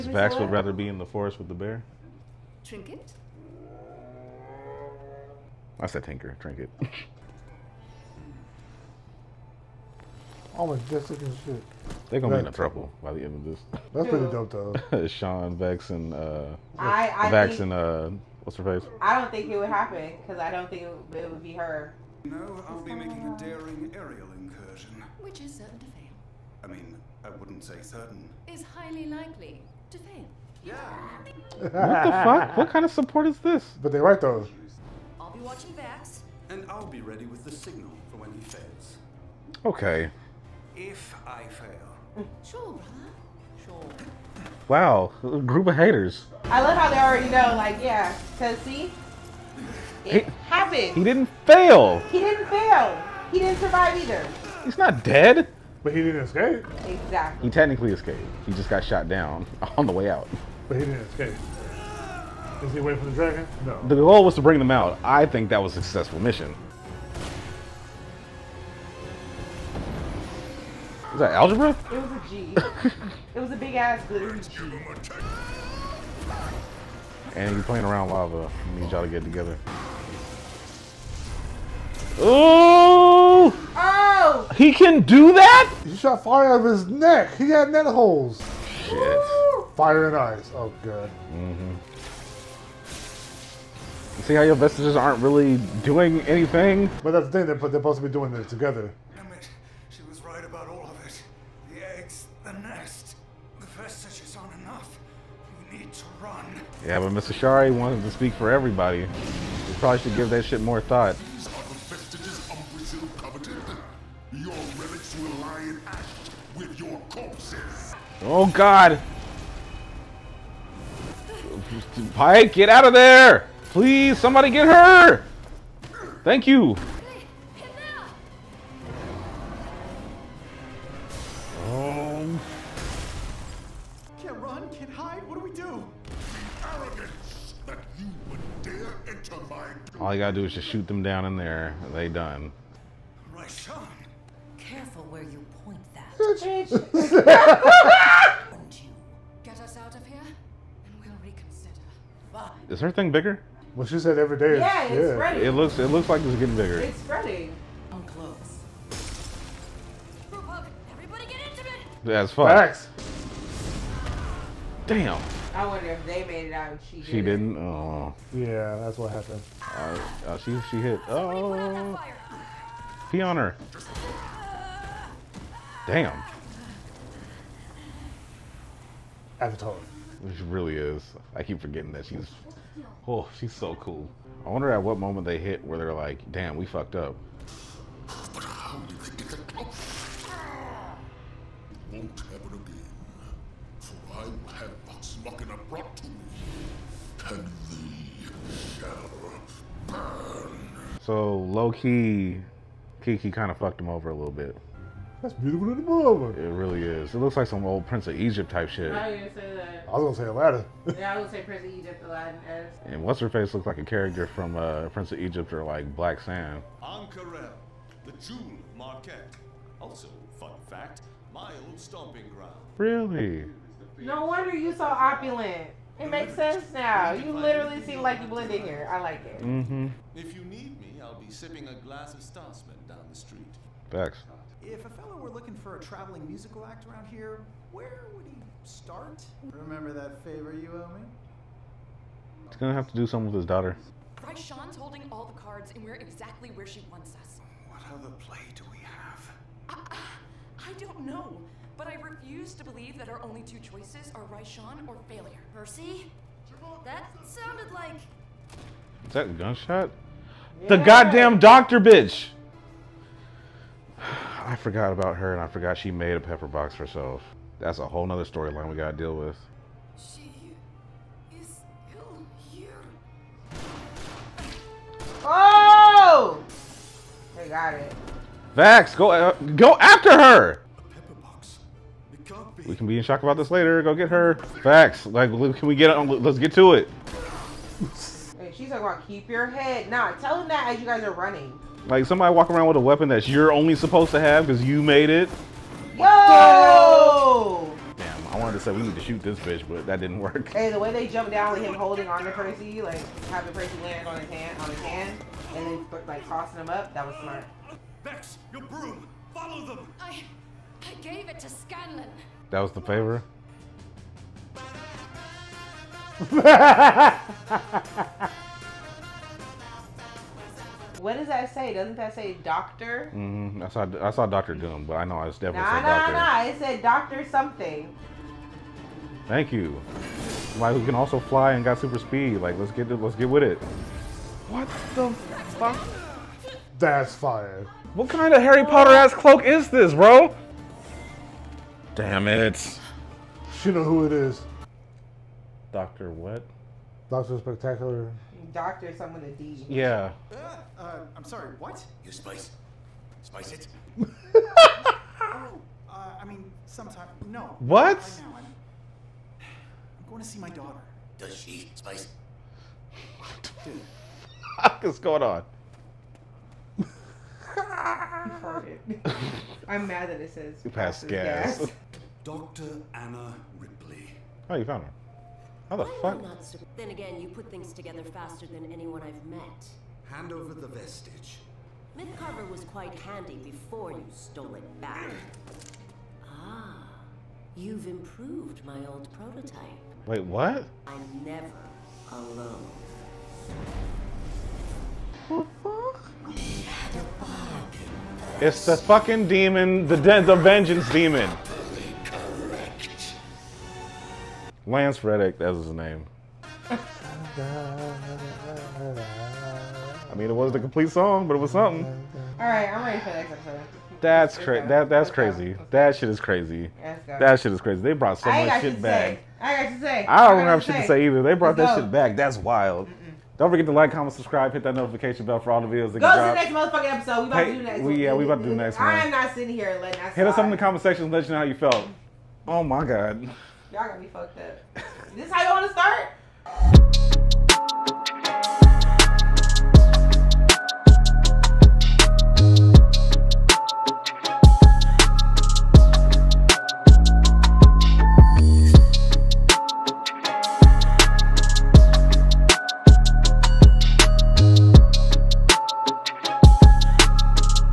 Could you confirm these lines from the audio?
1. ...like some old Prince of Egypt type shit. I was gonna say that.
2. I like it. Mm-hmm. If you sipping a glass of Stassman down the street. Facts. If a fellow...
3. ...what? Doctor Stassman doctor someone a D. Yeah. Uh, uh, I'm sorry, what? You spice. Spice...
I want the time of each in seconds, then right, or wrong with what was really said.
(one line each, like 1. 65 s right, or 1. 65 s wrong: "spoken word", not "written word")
1. 207 s right
2. 228 s right
3. 346 s wrong: "Spectacular", not "Stassman".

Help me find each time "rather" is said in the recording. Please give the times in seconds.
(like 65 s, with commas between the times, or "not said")
0 s.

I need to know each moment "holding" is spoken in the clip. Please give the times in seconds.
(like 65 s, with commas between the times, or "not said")
244 s, 301 s.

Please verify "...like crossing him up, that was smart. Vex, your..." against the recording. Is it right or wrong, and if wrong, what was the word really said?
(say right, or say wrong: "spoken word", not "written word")
right.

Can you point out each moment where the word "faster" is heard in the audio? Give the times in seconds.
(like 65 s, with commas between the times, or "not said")
378 s.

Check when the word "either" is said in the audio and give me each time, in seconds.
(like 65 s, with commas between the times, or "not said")
54 s, 421 s.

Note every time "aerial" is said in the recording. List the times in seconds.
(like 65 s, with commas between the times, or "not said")
23 s.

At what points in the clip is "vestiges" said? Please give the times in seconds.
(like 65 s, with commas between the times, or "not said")
94 s, 380 s.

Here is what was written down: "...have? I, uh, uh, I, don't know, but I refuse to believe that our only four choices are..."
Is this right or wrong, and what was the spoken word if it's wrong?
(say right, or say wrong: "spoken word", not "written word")
wrong: "two", not "four".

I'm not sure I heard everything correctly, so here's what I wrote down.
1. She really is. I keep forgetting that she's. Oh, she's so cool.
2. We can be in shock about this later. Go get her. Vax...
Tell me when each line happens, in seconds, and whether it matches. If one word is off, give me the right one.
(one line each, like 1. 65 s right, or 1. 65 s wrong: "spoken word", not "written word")
1. 180 s right
2. 282 s right.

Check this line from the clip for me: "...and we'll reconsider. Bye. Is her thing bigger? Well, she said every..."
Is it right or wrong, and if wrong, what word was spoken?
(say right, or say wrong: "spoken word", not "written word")
right.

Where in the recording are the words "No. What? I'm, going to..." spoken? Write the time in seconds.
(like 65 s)
357 s.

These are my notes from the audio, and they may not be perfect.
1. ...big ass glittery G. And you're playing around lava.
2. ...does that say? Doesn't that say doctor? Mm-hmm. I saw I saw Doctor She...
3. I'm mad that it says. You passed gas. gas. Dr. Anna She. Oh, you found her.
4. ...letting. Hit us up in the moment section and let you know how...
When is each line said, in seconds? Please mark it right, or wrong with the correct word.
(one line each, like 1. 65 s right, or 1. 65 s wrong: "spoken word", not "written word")
1. 73 s right
2. 321 s wrong: "Doom", not "She"
3. 369 s wrong: "Ripley", not "She"
4. 429 s wrong: "comment", not "moment".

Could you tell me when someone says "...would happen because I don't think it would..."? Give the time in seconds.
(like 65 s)
19 s.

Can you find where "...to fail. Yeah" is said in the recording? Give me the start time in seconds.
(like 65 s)
29 s.